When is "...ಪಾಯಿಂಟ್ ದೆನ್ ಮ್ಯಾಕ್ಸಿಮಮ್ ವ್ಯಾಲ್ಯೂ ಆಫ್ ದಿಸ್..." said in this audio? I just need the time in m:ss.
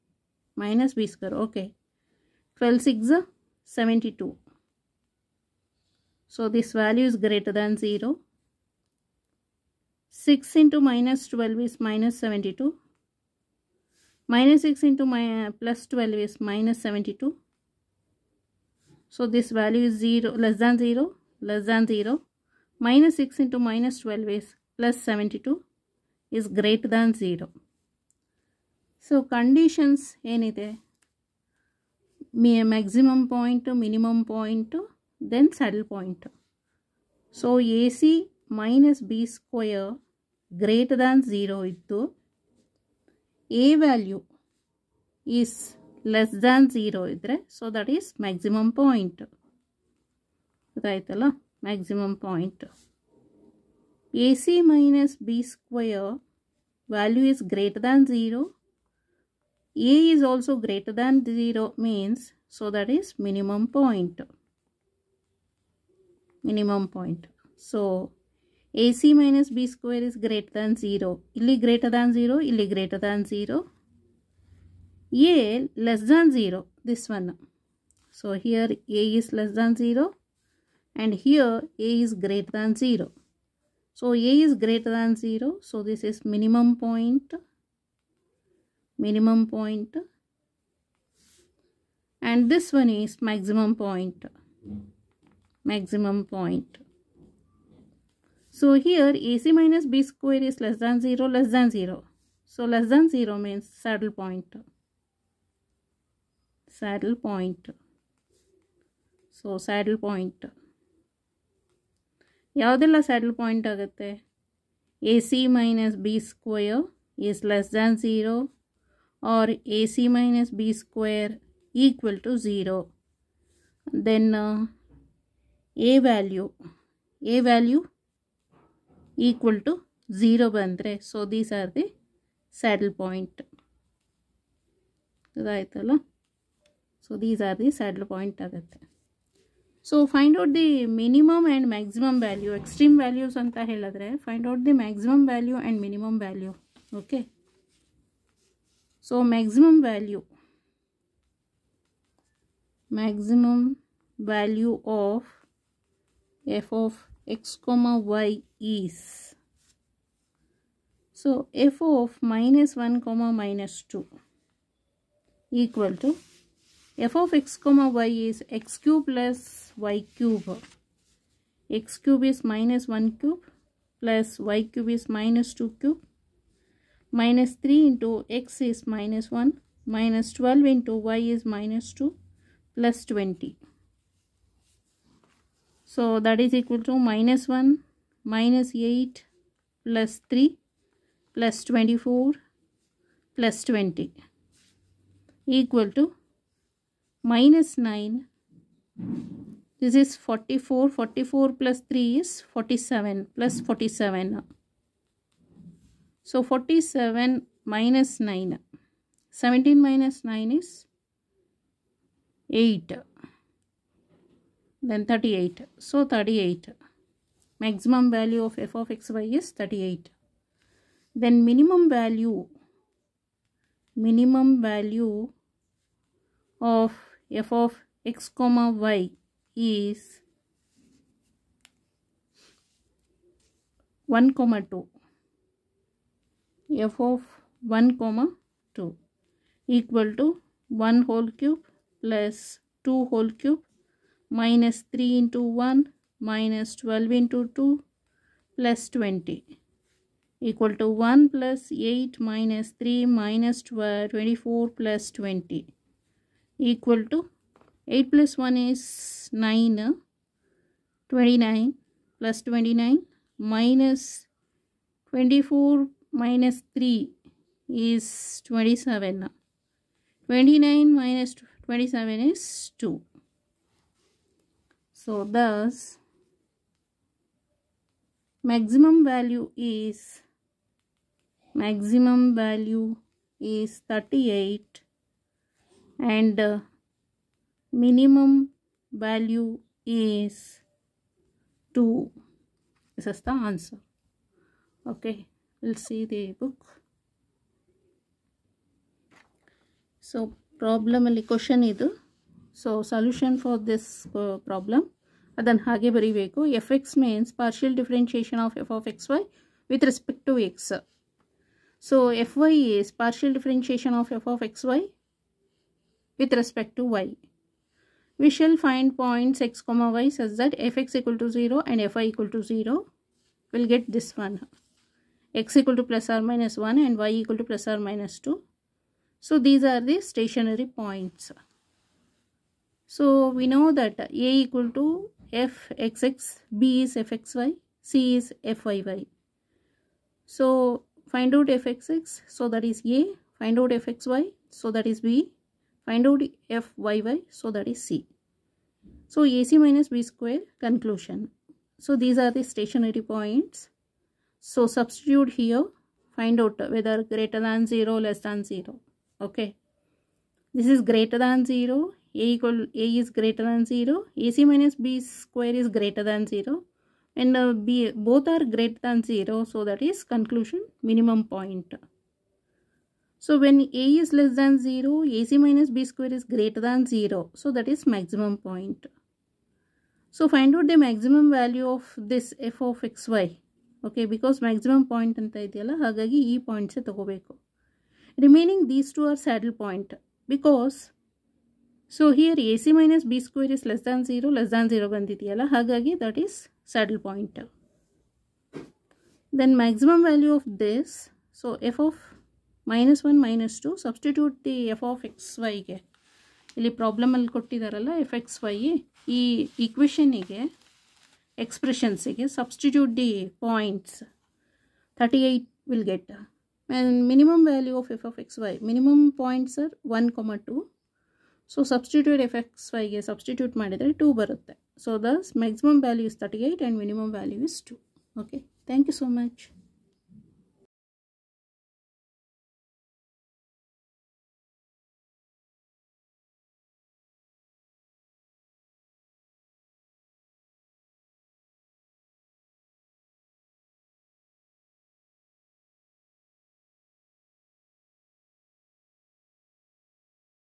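6:37.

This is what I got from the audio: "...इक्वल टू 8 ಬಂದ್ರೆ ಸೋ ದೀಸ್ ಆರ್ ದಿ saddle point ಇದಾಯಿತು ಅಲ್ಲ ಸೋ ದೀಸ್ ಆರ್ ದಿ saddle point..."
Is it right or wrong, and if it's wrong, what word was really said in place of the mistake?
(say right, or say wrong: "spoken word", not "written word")
wrong: "0", not "8".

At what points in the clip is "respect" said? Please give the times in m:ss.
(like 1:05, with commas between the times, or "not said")
5:09, 5:16.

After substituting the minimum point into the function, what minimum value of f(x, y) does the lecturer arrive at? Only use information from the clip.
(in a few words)
2.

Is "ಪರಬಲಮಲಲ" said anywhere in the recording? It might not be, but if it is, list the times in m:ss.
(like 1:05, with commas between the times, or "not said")
6:46.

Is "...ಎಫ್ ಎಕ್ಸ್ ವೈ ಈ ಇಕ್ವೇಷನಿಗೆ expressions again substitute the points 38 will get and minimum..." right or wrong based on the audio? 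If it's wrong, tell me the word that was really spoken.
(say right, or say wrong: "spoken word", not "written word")
right.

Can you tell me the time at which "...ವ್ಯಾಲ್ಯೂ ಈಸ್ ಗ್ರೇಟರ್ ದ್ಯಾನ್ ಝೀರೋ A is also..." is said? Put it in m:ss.
0:56.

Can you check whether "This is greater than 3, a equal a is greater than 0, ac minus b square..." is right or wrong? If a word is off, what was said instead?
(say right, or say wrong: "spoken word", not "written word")
wrong: "0", not "3".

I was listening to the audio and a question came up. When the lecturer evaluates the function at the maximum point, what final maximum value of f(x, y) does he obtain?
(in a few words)
38.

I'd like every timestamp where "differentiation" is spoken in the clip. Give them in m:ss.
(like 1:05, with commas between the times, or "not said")
5:07, 5:13.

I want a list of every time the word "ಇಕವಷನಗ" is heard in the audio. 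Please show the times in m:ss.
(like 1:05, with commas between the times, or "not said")
6:49.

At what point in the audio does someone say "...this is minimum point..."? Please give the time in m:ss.
1:25.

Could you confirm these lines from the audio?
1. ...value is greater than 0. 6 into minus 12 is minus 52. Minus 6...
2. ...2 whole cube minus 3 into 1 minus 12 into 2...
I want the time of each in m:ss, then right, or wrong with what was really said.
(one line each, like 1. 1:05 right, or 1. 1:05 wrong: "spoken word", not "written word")
1. 0:06 wrong: "72", not "52"
2. 4:02 right.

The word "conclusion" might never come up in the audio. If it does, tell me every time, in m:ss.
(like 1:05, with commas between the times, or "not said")
5:50, 6:10.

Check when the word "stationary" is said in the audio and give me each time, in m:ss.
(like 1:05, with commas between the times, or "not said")
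5:30, 5:52.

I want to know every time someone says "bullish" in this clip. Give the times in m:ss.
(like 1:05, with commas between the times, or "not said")
not said.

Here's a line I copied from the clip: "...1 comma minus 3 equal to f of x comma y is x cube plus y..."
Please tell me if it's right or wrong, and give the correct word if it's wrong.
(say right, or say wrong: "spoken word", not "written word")
wrong: "2", not "3".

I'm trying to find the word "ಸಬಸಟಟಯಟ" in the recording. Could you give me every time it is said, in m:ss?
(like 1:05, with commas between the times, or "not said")
6:43.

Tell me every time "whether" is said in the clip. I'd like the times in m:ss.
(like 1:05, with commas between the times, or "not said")
5:56.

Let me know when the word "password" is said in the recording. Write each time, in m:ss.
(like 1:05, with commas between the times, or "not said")
not said.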